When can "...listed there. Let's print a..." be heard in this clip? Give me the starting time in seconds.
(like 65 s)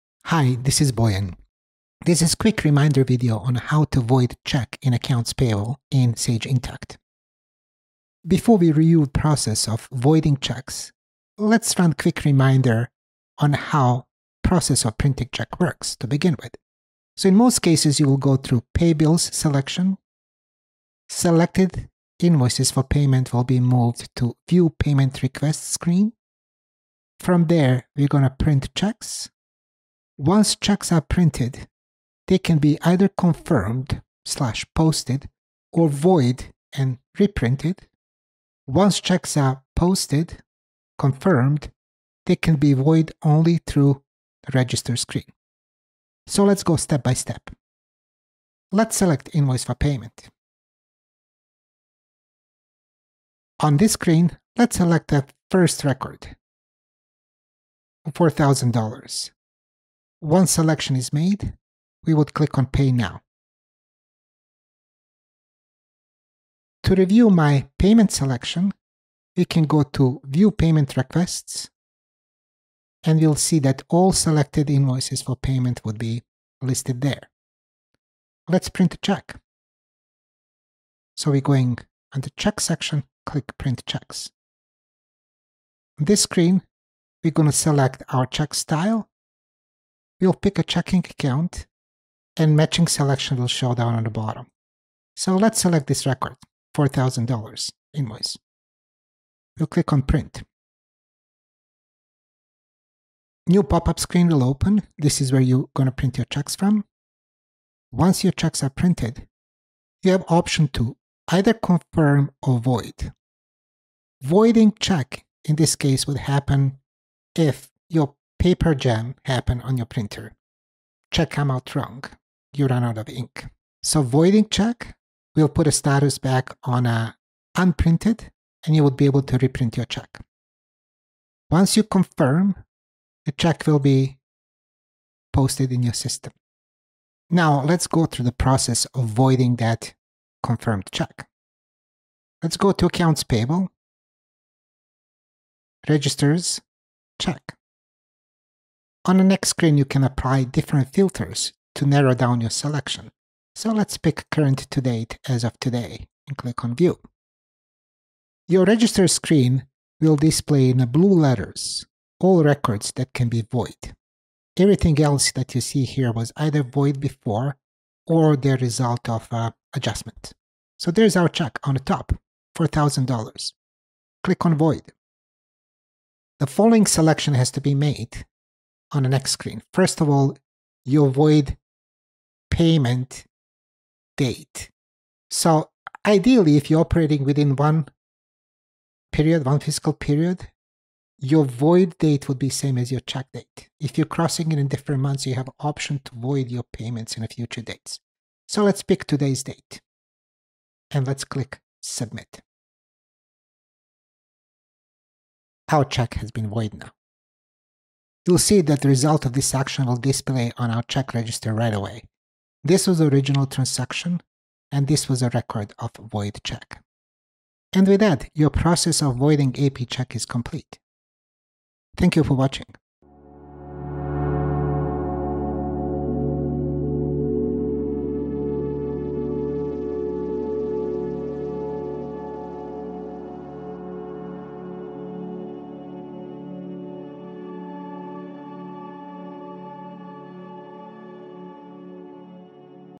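76 s.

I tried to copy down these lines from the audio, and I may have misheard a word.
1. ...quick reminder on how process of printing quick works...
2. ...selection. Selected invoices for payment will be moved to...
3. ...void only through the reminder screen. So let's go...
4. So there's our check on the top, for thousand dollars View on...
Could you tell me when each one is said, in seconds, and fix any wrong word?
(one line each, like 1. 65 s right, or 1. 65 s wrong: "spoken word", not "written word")
1. 11 s wrong: "check", not "quick"
2. 19 s right
3. 42 s wrong: "register", not "reminder"
4. 170 s wrong: "Click", not "View".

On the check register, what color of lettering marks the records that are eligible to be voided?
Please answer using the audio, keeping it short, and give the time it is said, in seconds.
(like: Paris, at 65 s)
Blue, at 160 s.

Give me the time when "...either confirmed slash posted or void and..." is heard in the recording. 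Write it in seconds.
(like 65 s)
32 s.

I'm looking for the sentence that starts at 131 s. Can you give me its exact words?
Once you confirm, the check will be posted in your system.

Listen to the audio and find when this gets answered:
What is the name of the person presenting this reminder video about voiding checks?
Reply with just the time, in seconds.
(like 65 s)
0 s.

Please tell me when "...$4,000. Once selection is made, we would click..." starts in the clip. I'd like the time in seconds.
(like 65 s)
58 s.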